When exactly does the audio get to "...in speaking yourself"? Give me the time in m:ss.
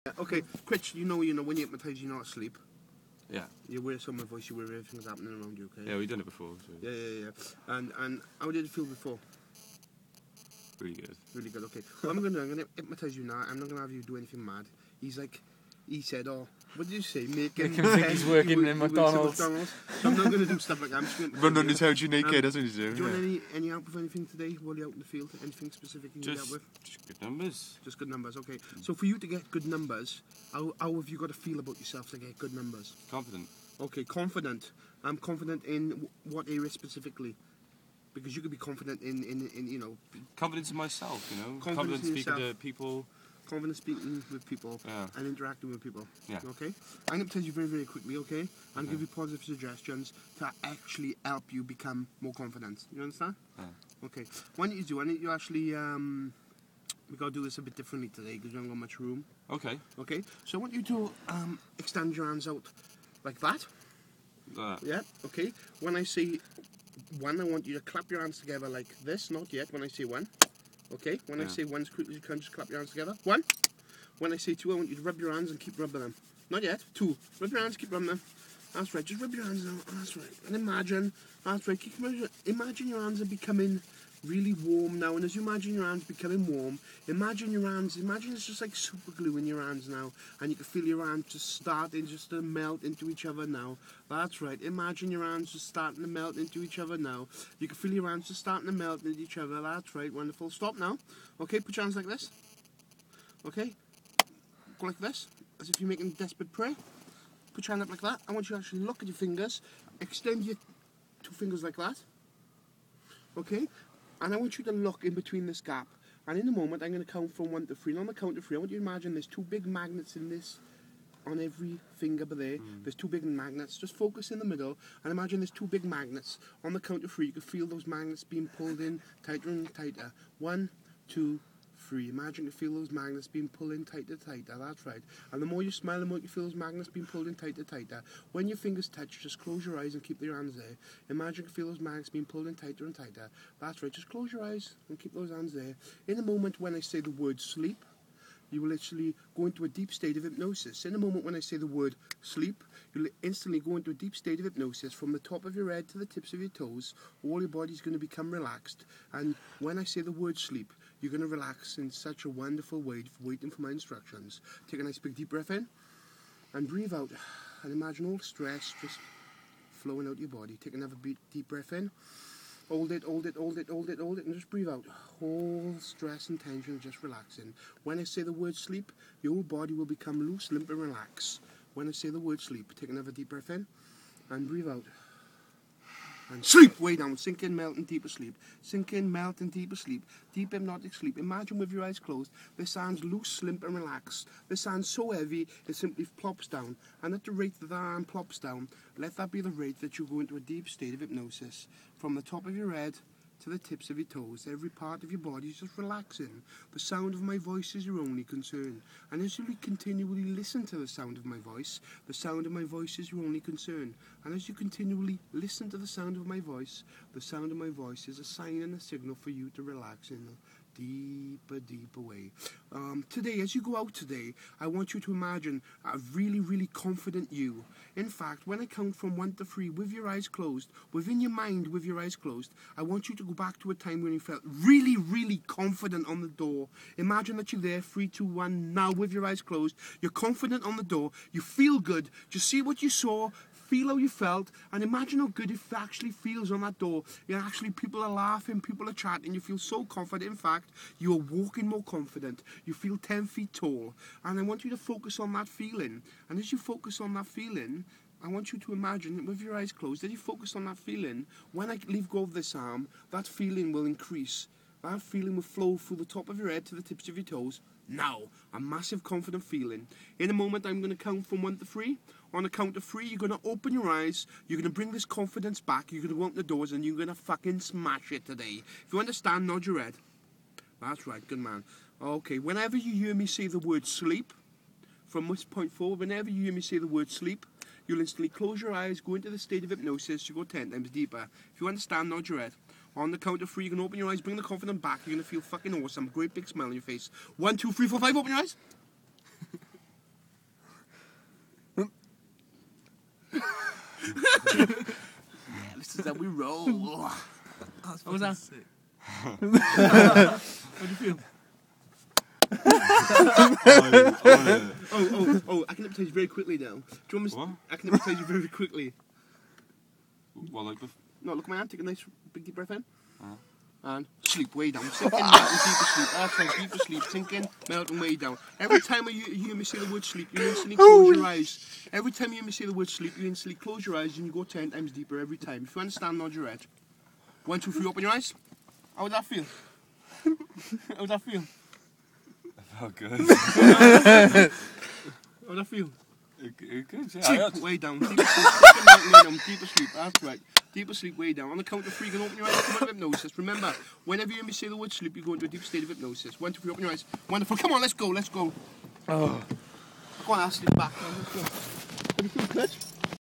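0:42.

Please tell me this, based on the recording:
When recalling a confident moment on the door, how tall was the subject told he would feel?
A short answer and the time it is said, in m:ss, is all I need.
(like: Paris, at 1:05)
10 feet, at 4:12.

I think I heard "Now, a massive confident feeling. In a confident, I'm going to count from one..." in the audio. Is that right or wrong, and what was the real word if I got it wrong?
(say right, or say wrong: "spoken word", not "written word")
wrong: "moment", not "confident".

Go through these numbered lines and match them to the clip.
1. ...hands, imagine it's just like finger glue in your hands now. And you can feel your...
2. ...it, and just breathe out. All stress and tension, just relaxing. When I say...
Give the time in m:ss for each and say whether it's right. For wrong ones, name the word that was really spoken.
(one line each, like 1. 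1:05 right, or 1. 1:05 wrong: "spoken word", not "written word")
1. 1:27 wrong: "super", not "finger"
2. 2:54 right.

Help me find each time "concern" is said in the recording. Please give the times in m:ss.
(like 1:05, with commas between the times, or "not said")
3:28, 3:33.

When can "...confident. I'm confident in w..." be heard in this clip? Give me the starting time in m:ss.
0:34.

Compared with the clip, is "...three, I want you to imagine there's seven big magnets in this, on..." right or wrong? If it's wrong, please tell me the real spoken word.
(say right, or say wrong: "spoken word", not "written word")
wrong: "two", not "seven".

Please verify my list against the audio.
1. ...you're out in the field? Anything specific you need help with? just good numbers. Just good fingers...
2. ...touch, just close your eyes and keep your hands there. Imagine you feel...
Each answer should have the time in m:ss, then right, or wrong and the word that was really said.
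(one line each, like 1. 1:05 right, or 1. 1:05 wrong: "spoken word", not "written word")
1. 0:24 wrong: "numbers", not "fingers"
2. 2:18 right.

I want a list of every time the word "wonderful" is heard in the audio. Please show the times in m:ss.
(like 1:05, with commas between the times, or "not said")
1:40, 2:42, 5:57.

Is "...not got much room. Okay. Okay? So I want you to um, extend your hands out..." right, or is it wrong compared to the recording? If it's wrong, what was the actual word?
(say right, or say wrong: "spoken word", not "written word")
right.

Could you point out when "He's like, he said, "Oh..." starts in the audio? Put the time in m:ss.
0:14.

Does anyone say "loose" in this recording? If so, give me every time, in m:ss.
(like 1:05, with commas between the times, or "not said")
3:00, 3:13.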